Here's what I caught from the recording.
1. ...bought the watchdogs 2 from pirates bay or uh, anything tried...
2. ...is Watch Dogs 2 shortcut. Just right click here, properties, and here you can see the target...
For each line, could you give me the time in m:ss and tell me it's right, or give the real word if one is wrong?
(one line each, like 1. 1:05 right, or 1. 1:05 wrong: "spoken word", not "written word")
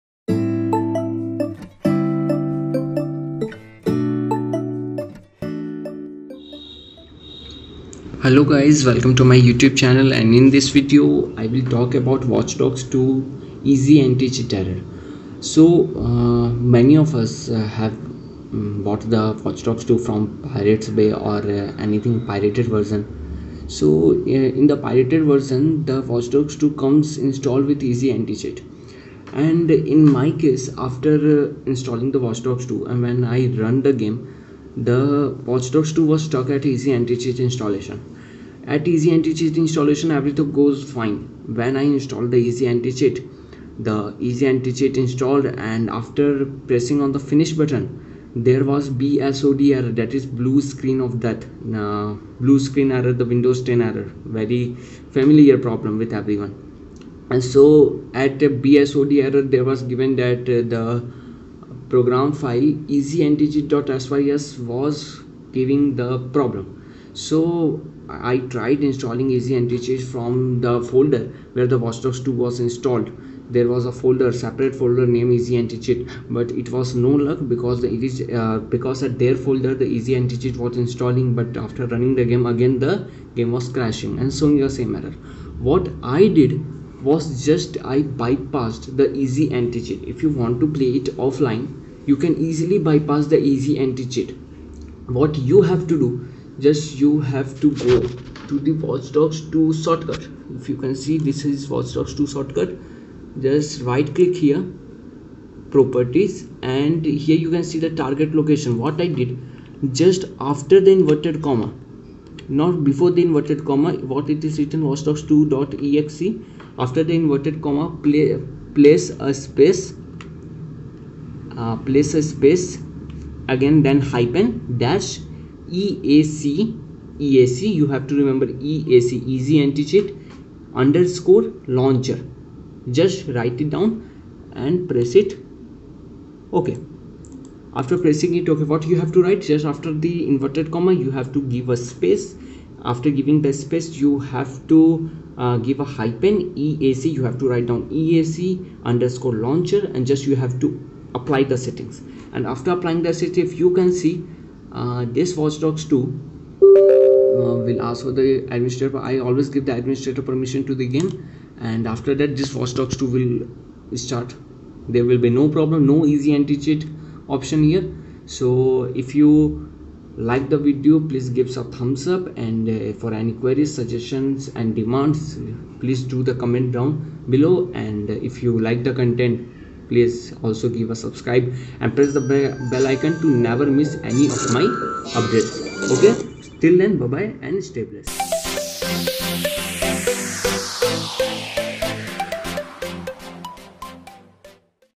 1. 0:18 wrong: "pirated", not "tried"
2. 1:41 right.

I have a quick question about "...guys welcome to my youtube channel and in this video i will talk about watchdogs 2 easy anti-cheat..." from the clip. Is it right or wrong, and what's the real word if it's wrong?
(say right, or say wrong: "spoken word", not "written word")
right.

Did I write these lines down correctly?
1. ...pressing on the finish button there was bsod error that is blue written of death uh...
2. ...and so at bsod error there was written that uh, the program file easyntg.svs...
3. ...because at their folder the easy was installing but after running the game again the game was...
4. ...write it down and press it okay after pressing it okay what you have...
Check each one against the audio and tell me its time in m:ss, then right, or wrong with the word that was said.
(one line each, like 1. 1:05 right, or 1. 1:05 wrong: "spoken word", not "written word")
1. 0:46 wrong: "screen", not "written"
2. 0:57 wrong: "given", not "written"
3. 1:18 right
4. 2:13 right.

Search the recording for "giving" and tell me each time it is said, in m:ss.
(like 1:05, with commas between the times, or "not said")
1:05, 2:23.